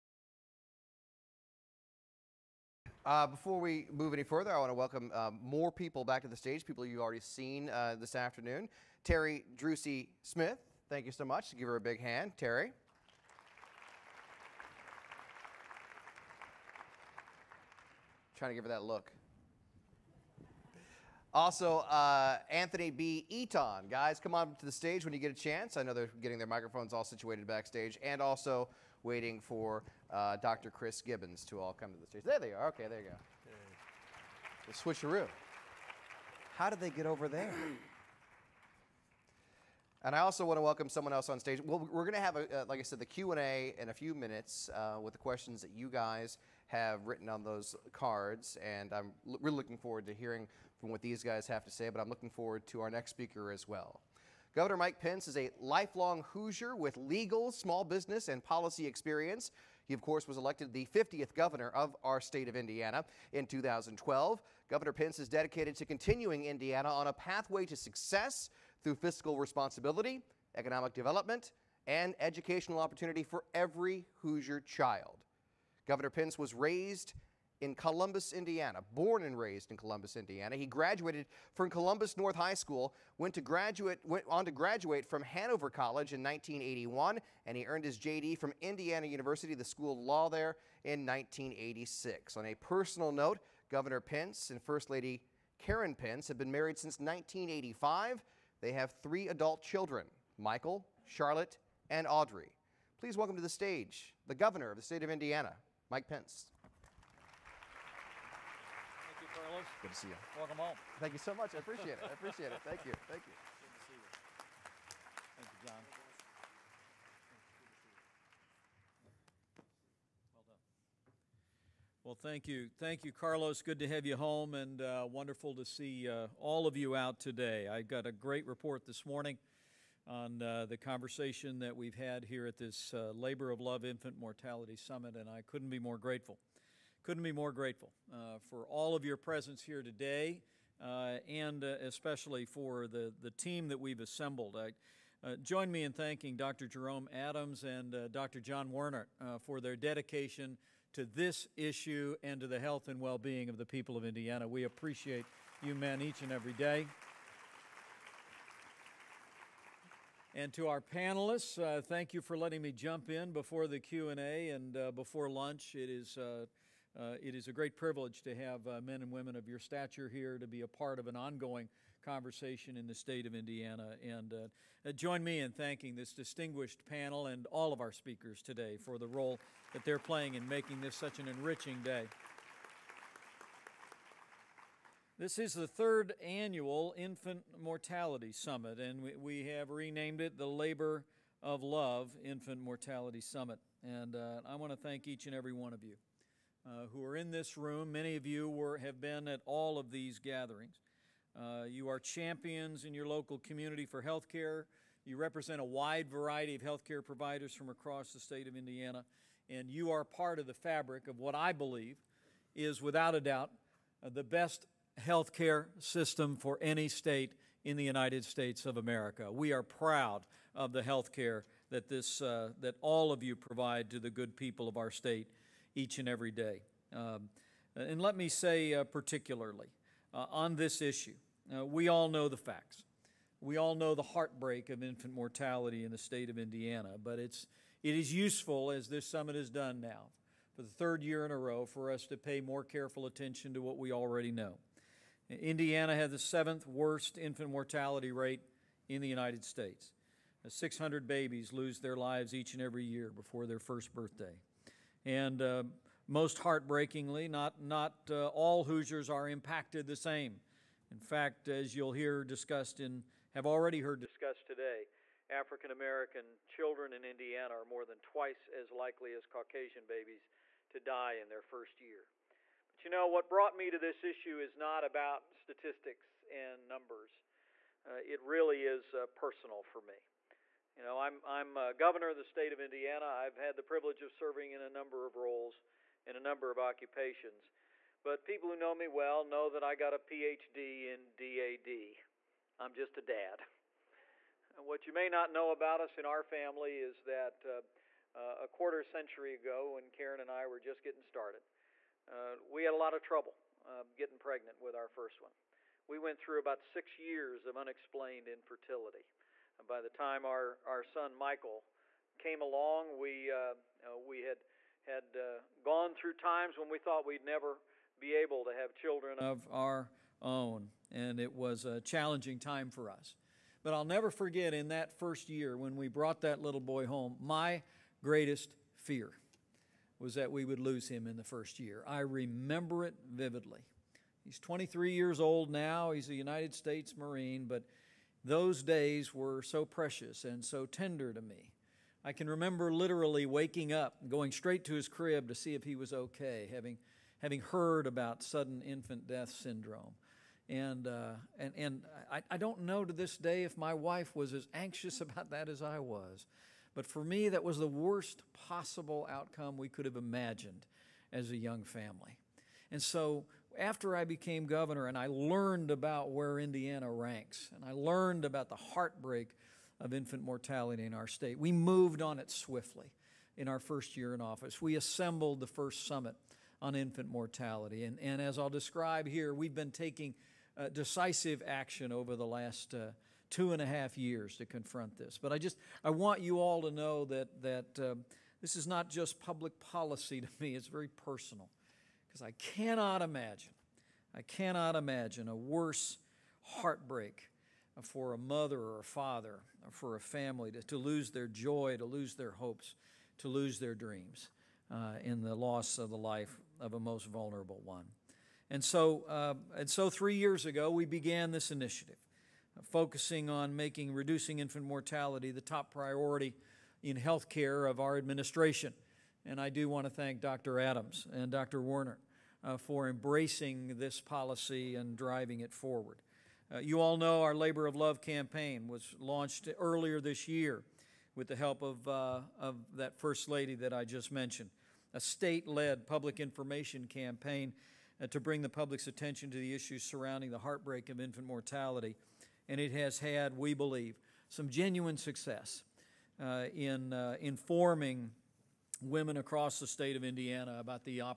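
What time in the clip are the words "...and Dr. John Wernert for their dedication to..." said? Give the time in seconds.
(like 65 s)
147 s.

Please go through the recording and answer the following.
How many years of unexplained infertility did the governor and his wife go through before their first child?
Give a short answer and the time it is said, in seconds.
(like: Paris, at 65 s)
Six years, at 306 s.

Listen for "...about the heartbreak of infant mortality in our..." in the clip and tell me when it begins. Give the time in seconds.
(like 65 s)
368 s.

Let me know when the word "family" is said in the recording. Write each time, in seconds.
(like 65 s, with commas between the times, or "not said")
296 s, 361 s, 399 s.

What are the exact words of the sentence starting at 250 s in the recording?
600 babies lose their lives each and every year before their first birthday.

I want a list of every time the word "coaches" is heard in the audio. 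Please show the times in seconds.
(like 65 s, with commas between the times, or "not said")
not said.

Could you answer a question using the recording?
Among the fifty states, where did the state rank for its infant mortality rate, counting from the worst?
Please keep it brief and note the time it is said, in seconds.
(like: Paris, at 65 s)
Seventh worst, at 246 s.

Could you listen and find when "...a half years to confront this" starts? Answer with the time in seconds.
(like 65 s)
383 s.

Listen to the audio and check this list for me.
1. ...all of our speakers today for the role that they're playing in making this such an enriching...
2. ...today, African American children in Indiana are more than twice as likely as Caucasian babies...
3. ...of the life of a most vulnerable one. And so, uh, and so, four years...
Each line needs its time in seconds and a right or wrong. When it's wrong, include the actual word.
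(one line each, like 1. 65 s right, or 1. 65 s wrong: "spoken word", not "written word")
1. 177 s right
2. 264 s right
3. 405 s wrong: "three", not "four".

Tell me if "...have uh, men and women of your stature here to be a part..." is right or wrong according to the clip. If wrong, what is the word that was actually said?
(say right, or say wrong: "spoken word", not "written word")
right.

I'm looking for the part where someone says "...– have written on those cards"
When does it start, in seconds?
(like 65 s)
46 s.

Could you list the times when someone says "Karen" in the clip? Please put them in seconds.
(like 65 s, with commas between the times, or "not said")
95 s, 299 s.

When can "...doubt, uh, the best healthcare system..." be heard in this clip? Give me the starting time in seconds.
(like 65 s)
213 s.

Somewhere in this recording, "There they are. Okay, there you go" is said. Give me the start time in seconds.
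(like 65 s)
32 s.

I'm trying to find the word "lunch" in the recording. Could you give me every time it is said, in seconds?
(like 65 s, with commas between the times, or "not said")
165 s.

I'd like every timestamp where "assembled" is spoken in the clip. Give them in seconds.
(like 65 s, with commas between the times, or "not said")
143 s, 374 s.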